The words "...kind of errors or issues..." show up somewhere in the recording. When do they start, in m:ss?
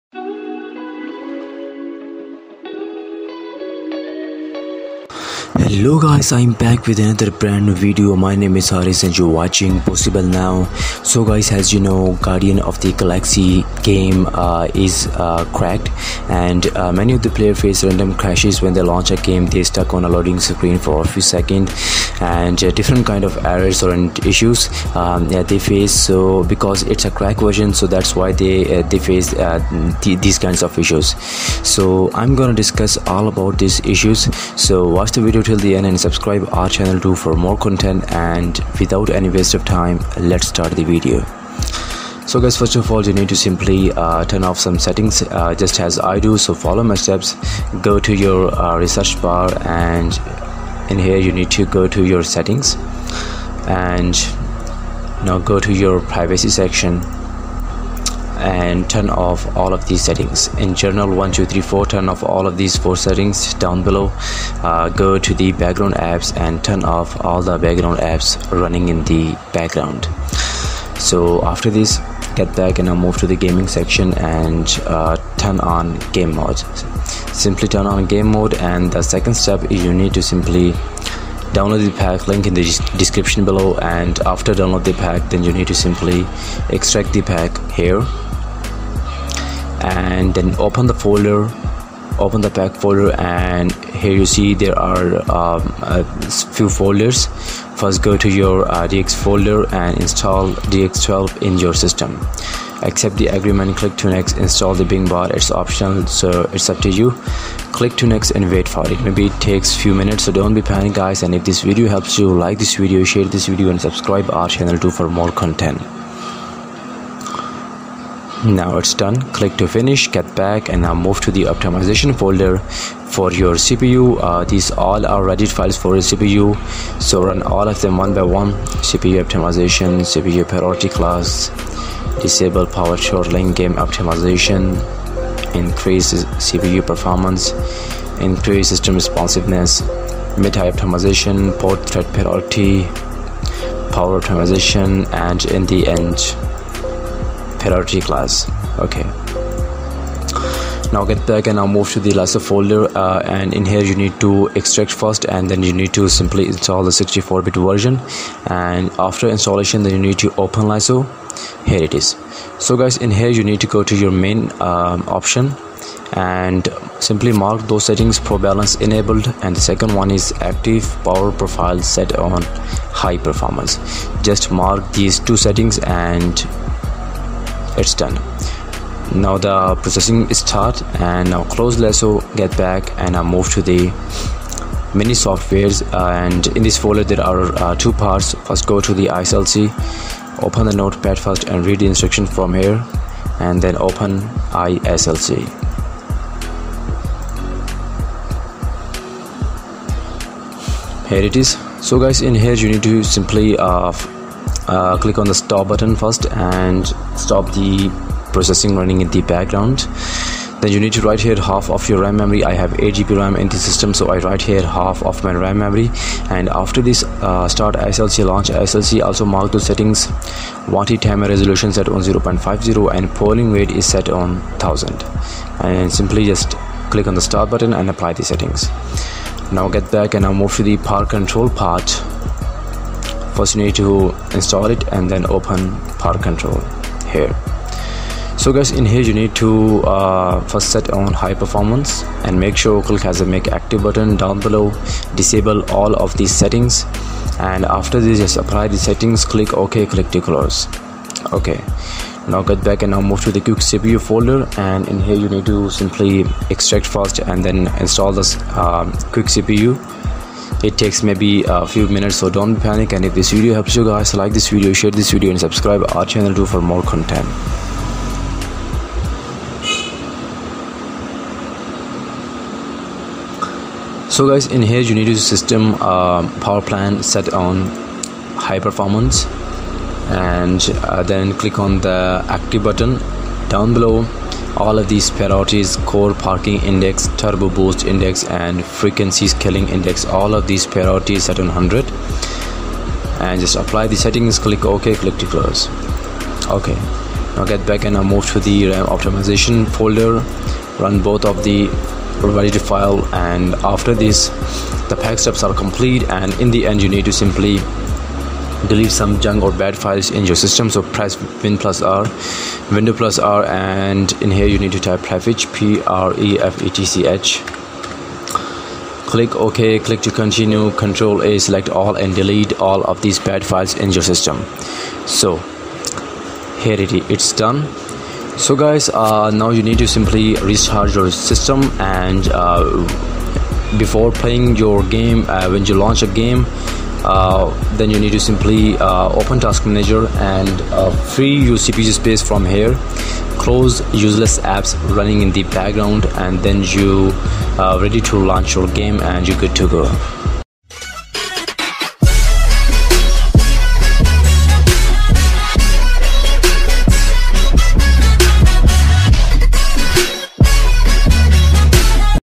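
0:23.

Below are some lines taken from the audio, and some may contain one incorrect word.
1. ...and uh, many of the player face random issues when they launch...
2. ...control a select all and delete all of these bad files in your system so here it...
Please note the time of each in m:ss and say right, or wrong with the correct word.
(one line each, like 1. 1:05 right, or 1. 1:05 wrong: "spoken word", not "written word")
1. 0:16 wrong: "crashes", not "issues"
2. 5:20 right.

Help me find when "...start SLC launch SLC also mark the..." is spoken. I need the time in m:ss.
3:37.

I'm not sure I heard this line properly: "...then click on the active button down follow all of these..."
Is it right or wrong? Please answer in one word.
wrong.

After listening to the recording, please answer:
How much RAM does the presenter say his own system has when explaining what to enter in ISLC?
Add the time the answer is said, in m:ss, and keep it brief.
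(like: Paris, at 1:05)
8GB, at 3:32.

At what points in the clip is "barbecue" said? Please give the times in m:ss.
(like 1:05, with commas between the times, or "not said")
not said.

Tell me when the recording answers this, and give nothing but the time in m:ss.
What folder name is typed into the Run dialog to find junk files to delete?
5:14.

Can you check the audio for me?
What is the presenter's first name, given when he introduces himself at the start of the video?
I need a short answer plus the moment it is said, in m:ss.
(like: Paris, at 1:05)
Haris, at 0:08.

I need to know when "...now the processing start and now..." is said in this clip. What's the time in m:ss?
2:59.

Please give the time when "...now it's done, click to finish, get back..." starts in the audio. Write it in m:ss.
1:58.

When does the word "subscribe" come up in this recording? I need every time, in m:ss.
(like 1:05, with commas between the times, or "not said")
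0:35, 1:53, 4:25.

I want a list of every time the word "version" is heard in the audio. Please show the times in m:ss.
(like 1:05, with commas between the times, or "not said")
0:27, 2:37.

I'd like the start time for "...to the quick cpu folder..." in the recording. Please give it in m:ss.
4:13.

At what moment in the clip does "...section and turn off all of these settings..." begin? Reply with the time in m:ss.
0:56.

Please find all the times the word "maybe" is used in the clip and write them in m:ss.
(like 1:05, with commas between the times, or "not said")
1:49, 4:21.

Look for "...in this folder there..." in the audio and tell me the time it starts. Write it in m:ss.
3:06.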